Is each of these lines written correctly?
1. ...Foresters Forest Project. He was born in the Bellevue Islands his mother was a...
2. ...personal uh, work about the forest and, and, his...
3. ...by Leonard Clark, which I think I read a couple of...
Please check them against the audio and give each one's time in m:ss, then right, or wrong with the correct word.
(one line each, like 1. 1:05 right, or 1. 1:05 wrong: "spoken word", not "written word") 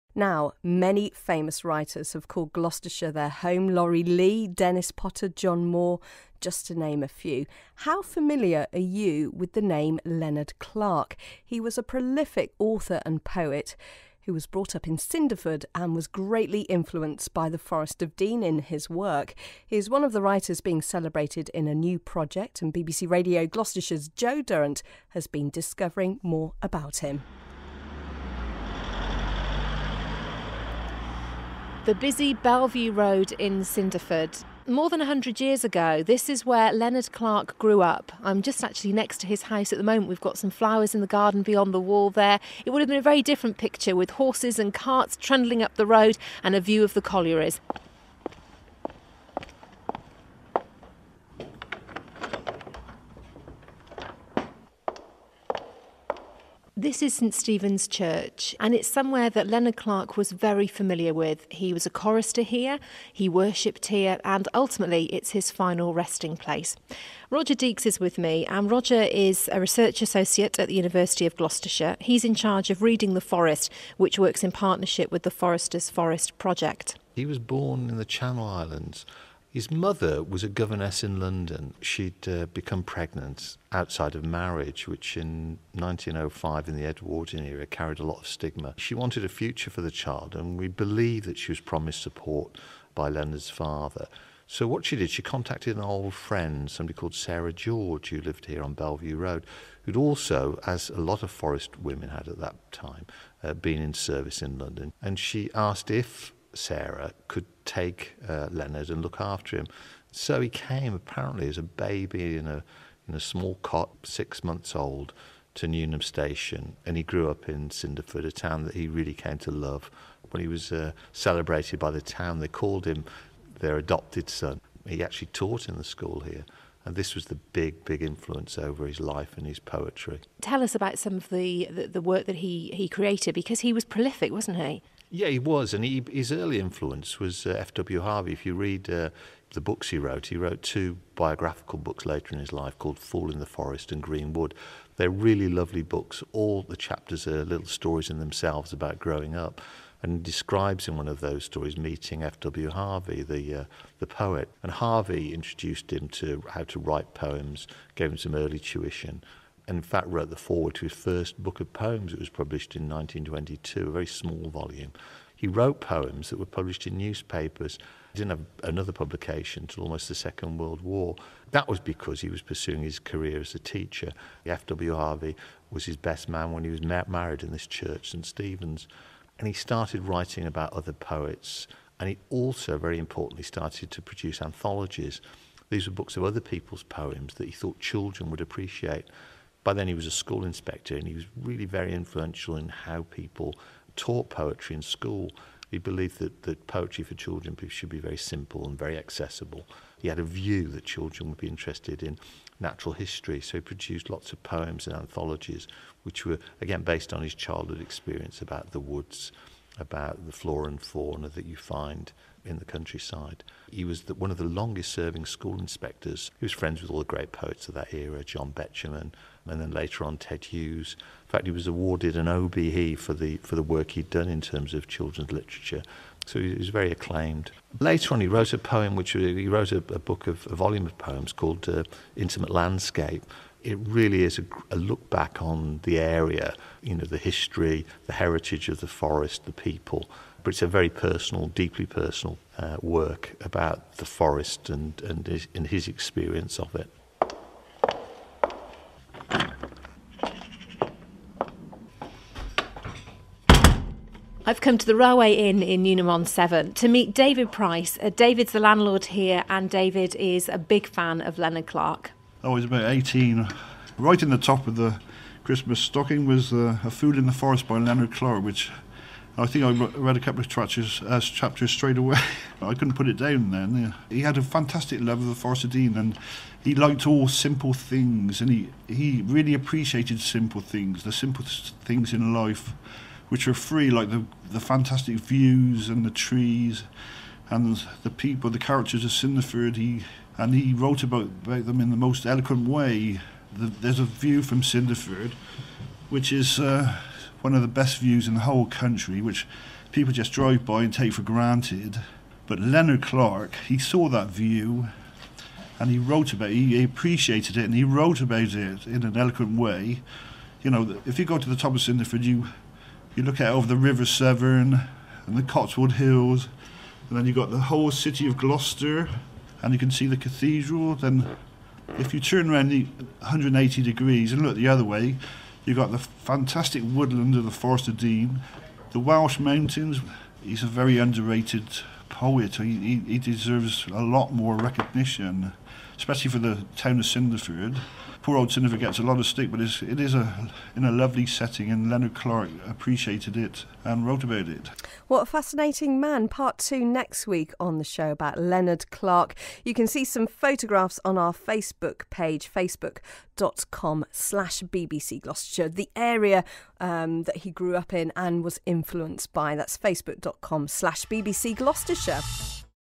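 1. 1:15 wrong: "Channel", not "Bellevue"
2. 4:01 right
3. 4:27 right.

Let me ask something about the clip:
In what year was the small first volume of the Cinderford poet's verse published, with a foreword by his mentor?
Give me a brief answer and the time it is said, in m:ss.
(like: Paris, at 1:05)
1922, at 2:42.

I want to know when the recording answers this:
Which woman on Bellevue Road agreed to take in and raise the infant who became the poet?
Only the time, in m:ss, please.
1:37.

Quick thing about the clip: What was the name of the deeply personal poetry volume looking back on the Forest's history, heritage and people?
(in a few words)
Intimate Landscape.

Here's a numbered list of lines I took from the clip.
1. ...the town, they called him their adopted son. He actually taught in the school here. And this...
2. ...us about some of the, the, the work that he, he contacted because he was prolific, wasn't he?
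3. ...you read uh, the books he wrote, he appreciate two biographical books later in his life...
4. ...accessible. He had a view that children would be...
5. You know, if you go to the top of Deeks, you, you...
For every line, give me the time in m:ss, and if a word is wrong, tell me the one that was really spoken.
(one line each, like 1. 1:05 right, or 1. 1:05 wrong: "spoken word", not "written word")
1. 2:01 right
2. 2:10 wrong: "created", not "contacted"
3. 2:18 wrong: "wrote", not "appreciate"
4. 3:18 right
5. 5:10 wrong: "Cinderford", not "Deeks".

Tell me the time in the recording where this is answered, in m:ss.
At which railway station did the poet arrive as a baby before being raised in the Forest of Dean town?
1:55.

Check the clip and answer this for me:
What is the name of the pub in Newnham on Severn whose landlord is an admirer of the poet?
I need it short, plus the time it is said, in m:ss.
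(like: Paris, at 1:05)
Railway Inn, at 4:14.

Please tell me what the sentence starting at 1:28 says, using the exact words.
She wanted a future for the child, and we believe that she was promised support by Leonard's father.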